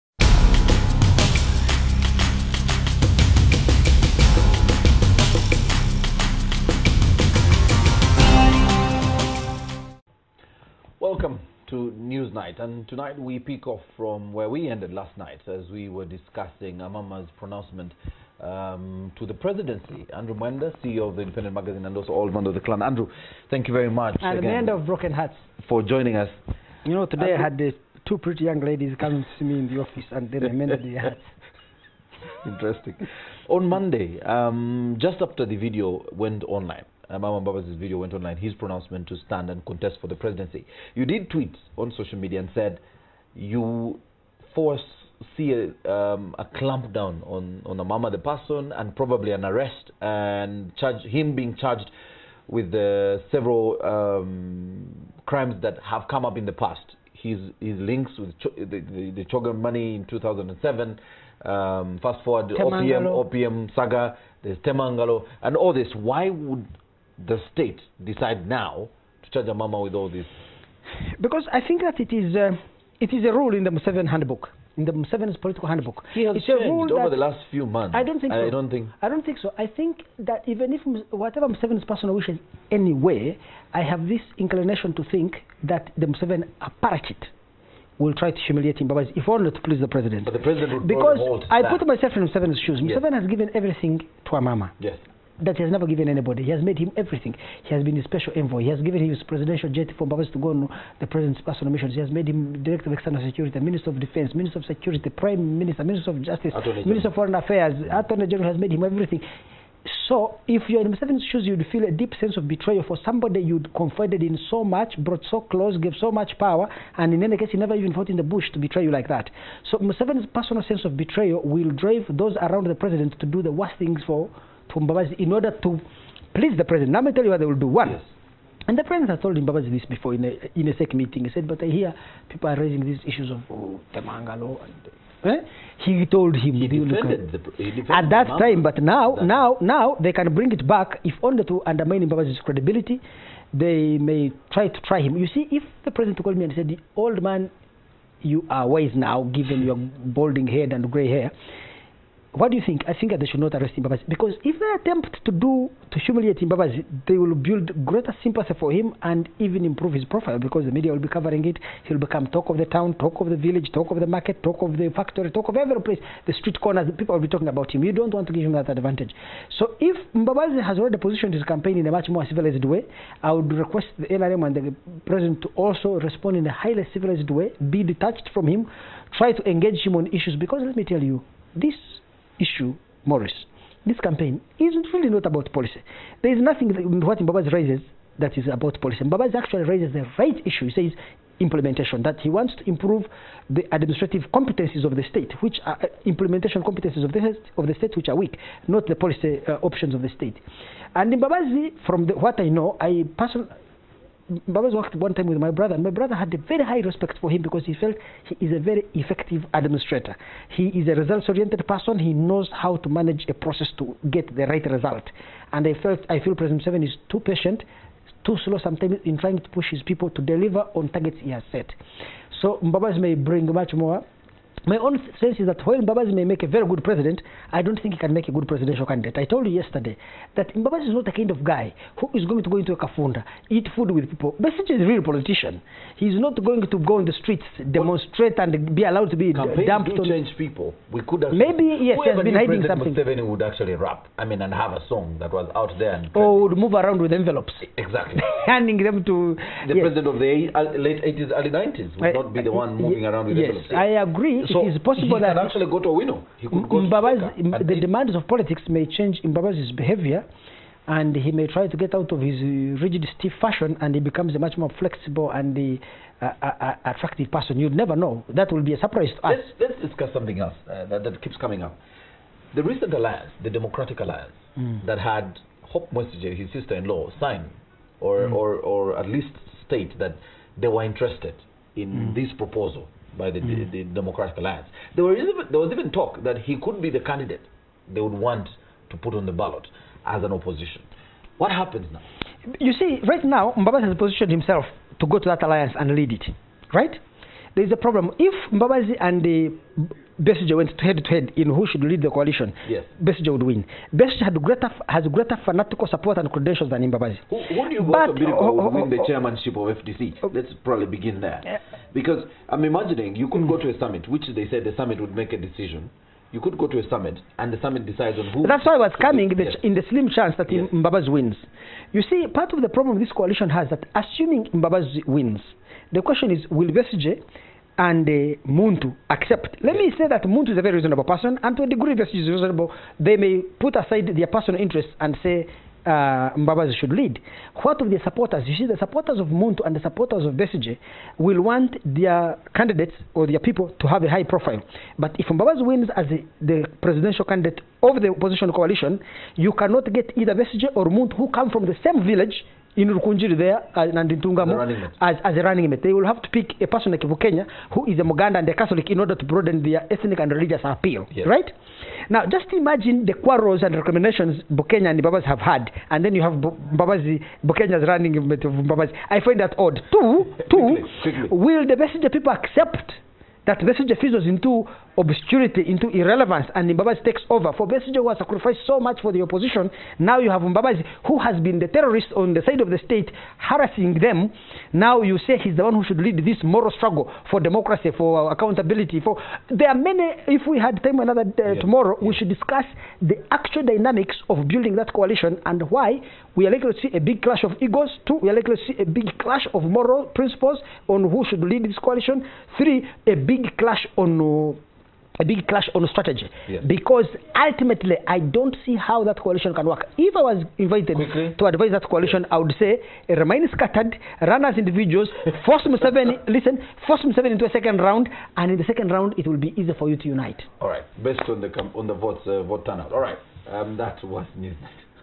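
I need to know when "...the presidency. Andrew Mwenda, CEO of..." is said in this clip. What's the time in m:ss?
0:19.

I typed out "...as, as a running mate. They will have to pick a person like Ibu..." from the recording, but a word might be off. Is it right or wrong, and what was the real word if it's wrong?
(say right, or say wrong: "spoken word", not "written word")
right.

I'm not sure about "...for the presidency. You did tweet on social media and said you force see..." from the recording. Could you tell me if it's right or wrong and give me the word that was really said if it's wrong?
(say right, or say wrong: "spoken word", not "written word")
right.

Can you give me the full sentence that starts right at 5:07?
Who, who do you but, go to Birico oh, win the chairmanship of FDC?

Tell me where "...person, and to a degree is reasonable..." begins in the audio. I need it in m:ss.
5:31.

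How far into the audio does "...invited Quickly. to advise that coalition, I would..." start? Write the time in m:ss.
6:50.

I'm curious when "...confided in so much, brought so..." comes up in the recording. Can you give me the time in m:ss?
1:53.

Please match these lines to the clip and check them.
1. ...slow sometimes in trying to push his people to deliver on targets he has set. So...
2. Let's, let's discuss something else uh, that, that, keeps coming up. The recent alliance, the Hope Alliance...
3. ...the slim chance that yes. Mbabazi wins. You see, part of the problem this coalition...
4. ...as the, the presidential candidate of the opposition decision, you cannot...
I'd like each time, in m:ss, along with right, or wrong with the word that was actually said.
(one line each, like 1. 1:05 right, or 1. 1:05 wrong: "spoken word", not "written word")
1. 3:38 right
2. 4:29 wrong: "Democratic", not "Hope"
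3. 5:19 right
4. 5:45 wrong: "coalition", not "decision".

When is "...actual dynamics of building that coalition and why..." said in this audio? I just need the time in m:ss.
6:33.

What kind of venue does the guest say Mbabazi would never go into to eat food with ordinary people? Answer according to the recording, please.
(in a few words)
A kafunda.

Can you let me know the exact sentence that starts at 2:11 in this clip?
He said, but I hear people are raising these issues of oh, Temangalo.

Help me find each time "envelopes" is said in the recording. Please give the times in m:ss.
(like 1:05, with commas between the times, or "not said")
4:07, 4:13.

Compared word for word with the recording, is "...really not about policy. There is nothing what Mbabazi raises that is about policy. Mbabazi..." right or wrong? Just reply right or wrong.
right.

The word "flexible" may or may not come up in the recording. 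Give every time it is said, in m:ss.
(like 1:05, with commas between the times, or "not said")
4:24.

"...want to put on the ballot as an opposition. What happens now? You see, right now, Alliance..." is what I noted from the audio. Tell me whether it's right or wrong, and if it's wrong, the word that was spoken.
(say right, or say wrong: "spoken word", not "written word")
wrong: "Mbabazi", not "Alliance".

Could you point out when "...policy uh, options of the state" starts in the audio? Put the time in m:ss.
3:18.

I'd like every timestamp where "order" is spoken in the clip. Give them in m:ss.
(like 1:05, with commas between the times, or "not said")
2:05, 5:58.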